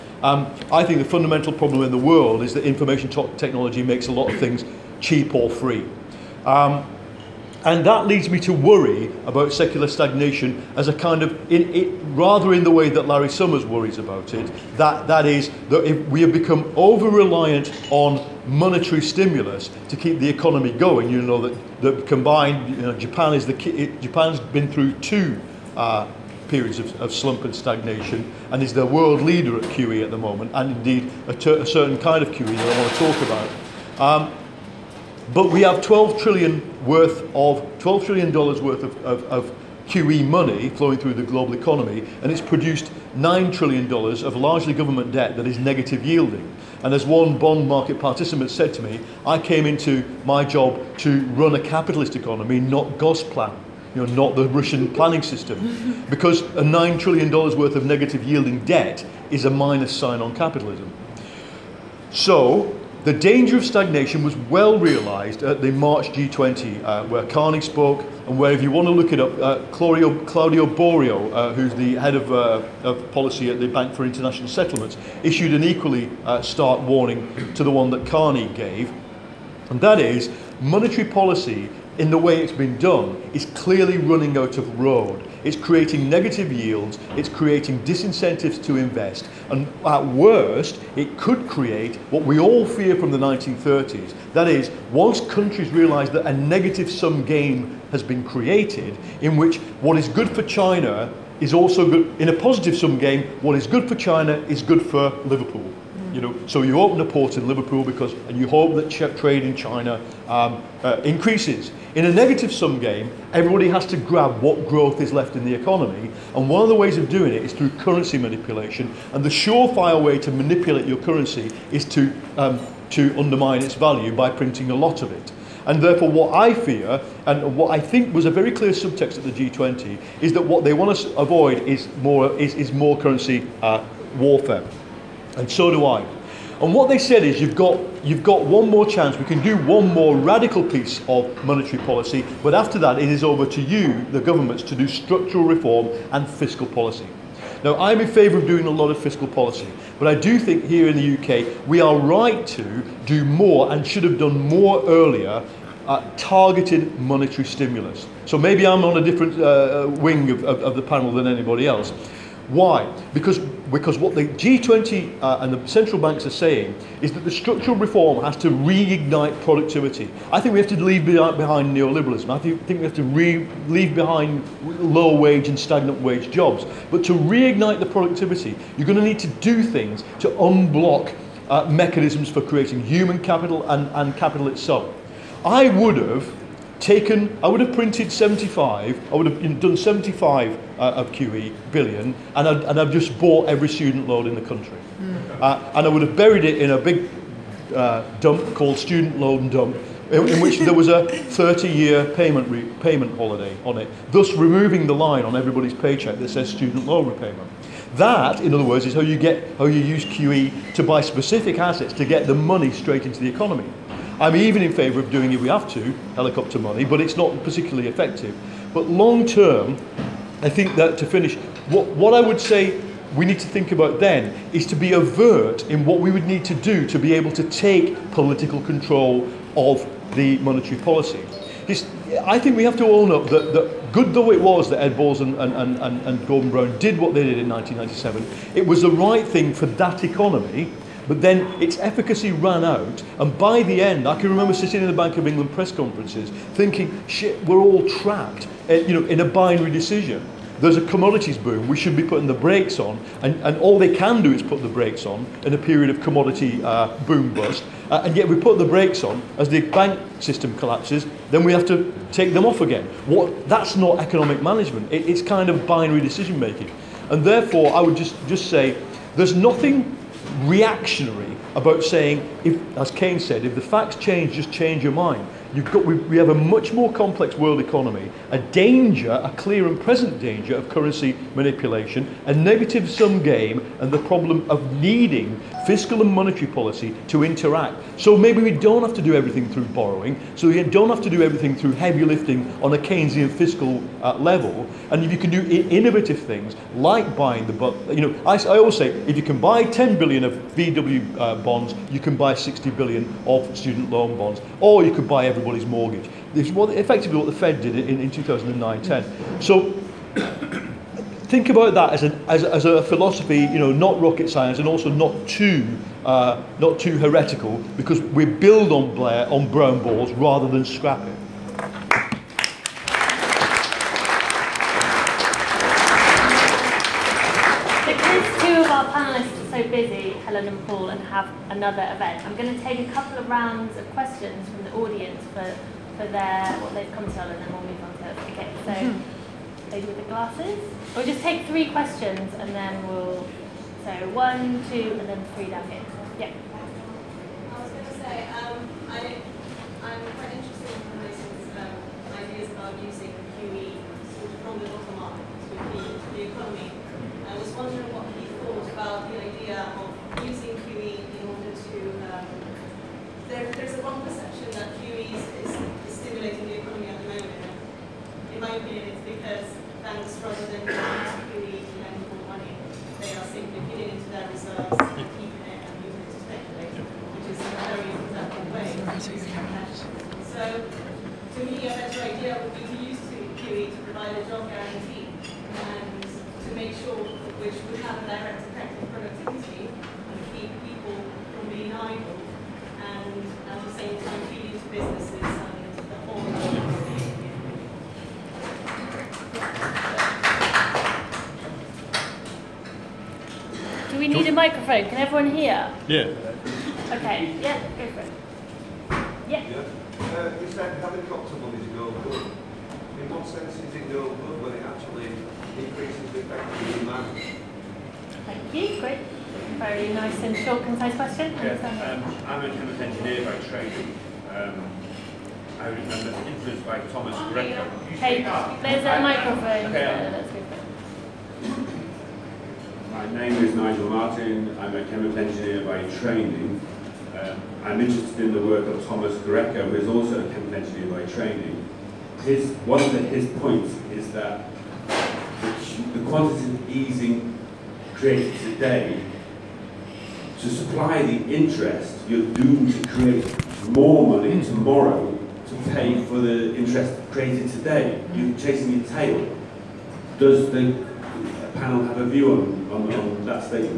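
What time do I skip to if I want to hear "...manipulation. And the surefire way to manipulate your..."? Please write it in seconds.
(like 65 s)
118 s.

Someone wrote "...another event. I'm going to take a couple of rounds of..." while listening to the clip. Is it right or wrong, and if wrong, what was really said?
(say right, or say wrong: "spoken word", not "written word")
right.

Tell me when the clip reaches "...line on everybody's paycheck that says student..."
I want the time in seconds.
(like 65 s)
204 s.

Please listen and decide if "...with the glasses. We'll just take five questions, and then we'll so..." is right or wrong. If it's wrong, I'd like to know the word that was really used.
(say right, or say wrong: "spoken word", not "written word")
wrong: "three", not "five".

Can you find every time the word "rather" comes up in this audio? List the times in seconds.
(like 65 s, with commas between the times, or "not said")
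12 s, 320 s, 370 s.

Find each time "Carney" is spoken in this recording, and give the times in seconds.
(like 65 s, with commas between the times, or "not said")
67 s, 78 s.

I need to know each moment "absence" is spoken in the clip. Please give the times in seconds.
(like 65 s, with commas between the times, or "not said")
not said.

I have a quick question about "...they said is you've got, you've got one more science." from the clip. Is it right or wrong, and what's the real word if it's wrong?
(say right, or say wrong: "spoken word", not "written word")
wrong: "chance", not "science".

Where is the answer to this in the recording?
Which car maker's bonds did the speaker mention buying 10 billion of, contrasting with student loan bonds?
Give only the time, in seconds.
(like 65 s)
300 s.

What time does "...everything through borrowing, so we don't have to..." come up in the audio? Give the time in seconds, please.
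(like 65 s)
289 s.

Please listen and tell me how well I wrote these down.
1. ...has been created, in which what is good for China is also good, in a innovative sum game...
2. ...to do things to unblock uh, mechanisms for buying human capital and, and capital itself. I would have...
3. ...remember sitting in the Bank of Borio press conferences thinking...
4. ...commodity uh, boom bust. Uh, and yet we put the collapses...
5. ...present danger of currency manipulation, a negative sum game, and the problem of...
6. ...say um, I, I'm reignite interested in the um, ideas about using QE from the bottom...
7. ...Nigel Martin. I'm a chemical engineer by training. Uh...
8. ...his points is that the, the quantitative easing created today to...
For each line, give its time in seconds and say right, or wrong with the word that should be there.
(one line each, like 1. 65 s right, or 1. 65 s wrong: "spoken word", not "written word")
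1. 97 s wrong: "positive", not "innovative"
2. 179 s wrong: "creating", not "buying"
3. 244 s wrong: "England", not "Borio"
4. 256 s wrong: "brakes", not "collapses"
5. 279 s right
6. 347 s wrong: "quite", not "reignite"
7. 433 s right
8. 442 s right.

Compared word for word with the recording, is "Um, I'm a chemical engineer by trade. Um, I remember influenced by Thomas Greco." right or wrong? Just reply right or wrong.
right.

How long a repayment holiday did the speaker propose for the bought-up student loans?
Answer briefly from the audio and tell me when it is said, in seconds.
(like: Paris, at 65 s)
30 years, at 201 s.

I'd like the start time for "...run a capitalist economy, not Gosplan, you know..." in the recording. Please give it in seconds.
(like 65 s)
51 s.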